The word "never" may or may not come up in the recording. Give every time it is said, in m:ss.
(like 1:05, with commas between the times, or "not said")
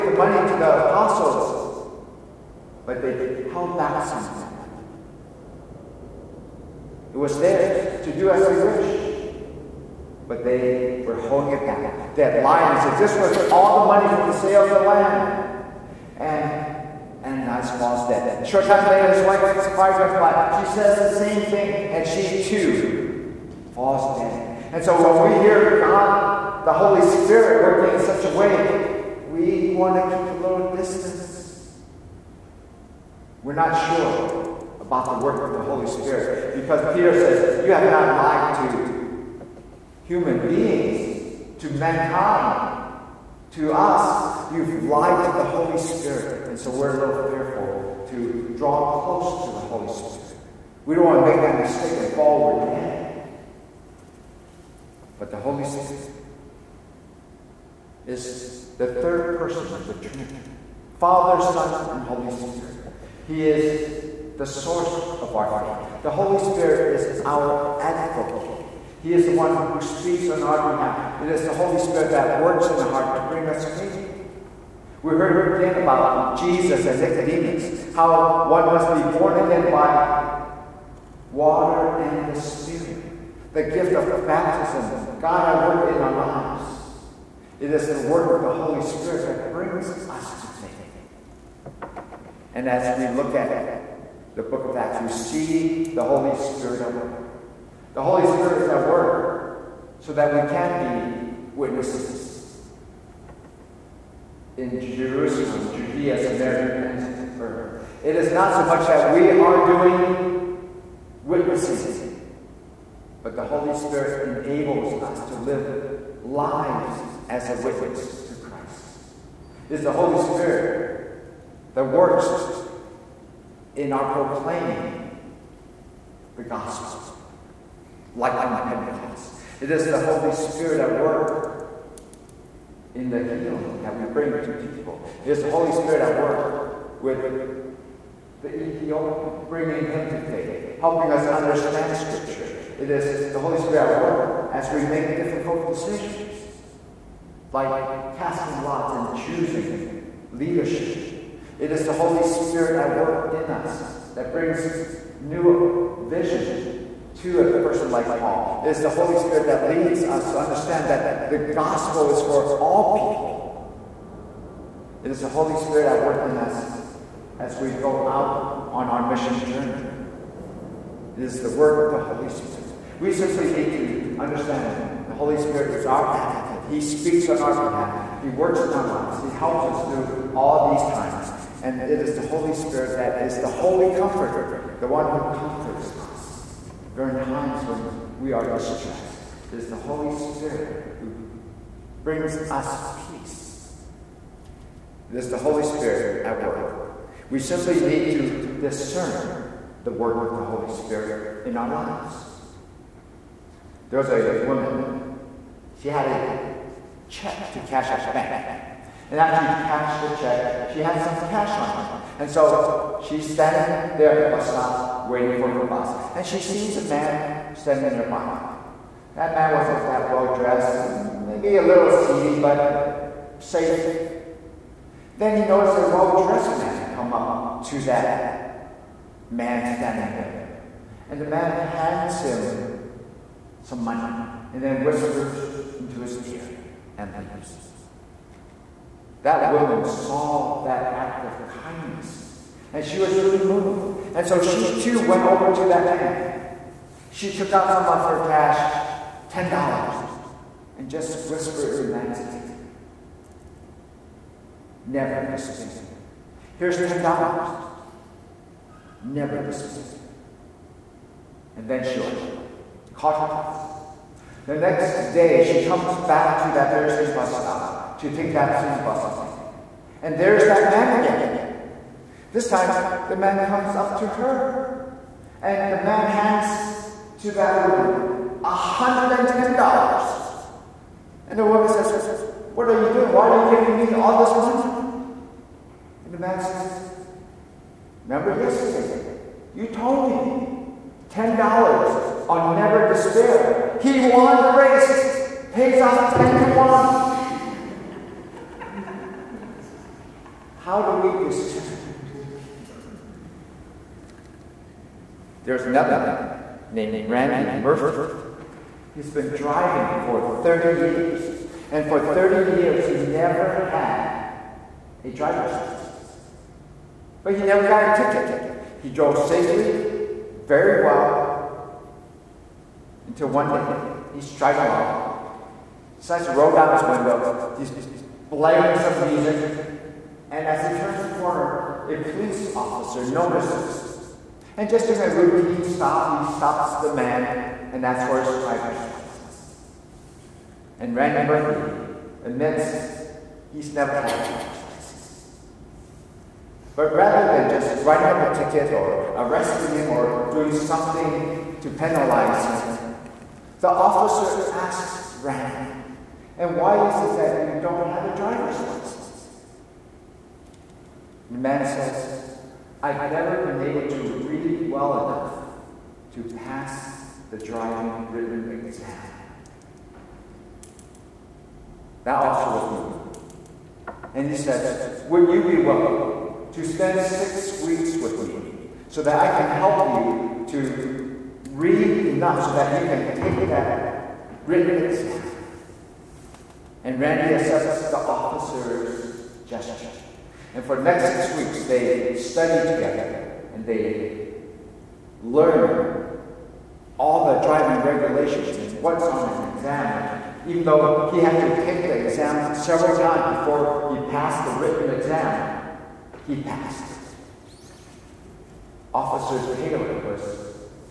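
4:14, 4:19, 4:52, 5:12, 5:17, 5:43, 6:03.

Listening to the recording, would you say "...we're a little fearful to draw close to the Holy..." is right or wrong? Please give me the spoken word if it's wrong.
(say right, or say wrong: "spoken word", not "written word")
right.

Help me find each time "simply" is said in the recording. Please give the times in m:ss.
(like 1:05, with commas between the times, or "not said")
2:53, 3:17.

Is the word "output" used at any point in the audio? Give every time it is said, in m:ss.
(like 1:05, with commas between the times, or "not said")
not said.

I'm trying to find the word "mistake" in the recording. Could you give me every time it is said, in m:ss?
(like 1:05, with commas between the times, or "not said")
0:51.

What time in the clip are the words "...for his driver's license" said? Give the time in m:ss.
5:38.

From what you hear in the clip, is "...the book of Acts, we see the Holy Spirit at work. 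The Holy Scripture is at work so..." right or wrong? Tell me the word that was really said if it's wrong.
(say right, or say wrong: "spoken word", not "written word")
wrong: "Spirit", not "Scripture".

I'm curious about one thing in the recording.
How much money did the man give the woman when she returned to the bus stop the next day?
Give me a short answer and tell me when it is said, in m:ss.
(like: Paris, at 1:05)
$110, at 4:38.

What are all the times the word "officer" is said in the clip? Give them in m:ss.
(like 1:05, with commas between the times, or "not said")
5:32, 5:53, 6:12, 6:27, 6:48.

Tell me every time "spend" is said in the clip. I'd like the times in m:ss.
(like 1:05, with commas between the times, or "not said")
6:16.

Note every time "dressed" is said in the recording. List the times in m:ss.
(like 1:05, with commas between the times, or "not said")
3:40, 3:46.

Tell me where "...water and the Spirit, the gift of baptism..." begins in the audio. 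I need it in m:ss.
1:21.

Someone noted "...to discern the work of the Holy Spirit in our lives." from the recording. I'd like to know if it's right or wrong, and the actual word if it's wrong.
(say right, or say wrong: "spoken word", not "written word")
right.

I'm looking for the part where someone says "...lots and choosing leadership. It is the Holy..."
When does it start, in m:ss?
2:28.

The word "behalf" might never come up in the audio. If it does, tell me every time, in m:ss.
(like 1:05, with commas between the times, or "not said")
1:10, 2:57.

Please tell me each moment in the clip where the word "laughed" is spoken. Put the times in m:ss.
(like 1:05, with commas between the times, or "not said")
not said.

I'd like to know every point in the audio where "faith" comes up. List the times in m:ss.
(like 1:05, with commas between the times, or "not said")
1:05, 1:13, 1:30, 2:20.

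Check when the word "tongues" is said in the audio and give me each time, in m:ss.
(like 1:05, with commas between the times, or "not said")
not said.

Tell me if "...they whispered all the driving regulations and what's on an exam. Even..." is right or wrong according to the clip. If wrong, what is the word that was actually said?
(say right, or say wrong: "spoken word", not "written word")
wrong: "learned", not "whispered".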